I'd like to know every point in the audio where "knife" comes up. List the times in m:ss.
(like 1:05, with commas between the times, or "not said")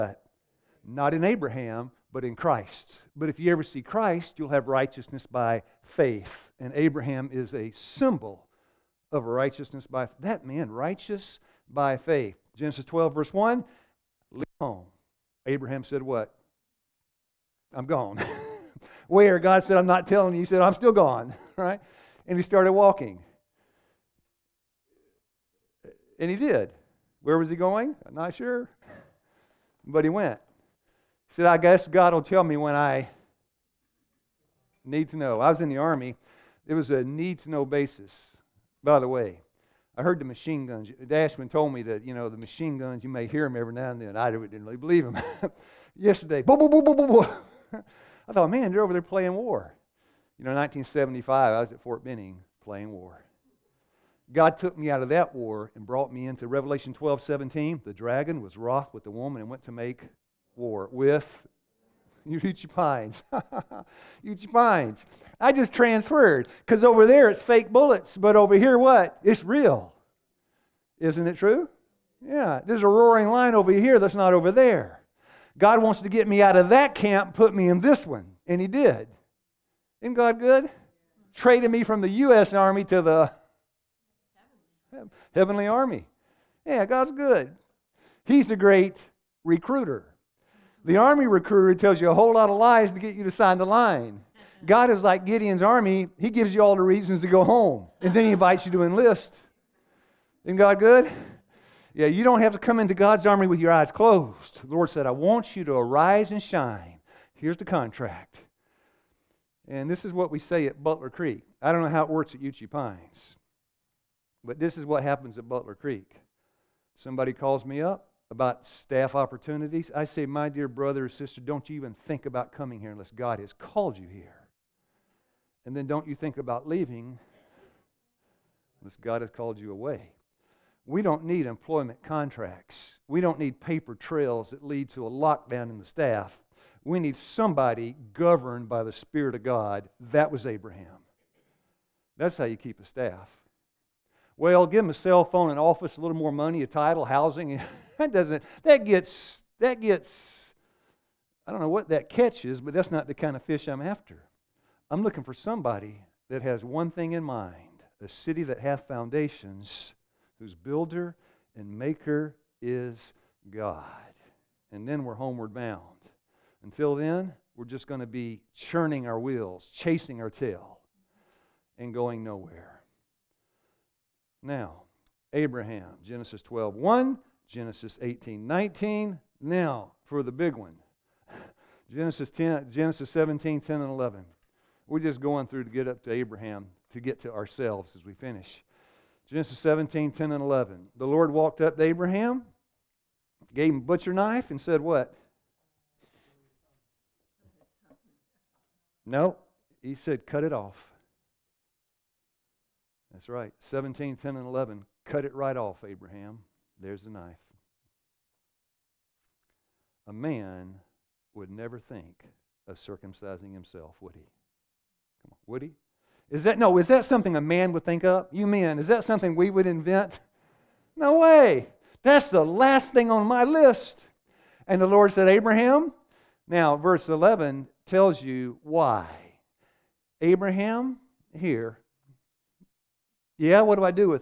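3:14, 3:27.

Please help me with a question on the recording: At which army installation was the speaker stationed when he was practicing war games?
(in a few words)
Fort Benning.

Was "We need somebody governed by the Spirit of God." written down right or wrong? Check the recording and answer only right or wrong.
right.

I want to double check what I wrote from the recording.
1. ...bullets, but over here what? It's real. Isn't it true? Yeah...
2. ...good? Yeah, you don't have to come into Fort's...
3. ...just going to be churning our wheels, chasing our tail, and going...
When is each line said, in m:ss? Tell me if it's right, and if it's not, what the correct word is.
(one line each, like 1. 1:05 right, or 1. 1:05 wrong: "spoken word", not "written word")
1. 1:07 right
2. 1:40 wrong: "God", not "Fort"
3. 2:47 right.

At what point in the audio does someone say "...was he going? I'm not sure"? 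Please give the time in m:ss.
0:27.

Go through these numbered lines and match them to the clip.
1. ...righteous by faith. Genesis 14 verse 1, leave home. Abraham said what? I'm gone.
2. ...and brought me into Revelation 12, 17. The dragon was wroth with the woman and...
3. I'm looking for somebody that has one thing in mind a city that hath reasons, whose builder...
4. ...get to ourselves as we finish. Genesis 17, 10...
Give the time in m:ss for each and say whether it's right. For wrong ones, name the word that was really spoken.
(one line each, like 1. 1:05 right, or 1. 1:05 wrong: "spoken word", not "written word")
1. 0:10 wrong: "12", not "14"
2. 0:55 right
3. 2:34 wrong: "foundations", not "reasons"
4. 3:07 right.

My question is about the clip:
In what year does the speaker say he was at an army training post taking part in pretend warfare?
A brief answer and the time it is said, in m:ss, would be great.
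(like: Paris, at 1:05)
1975, at 0:50.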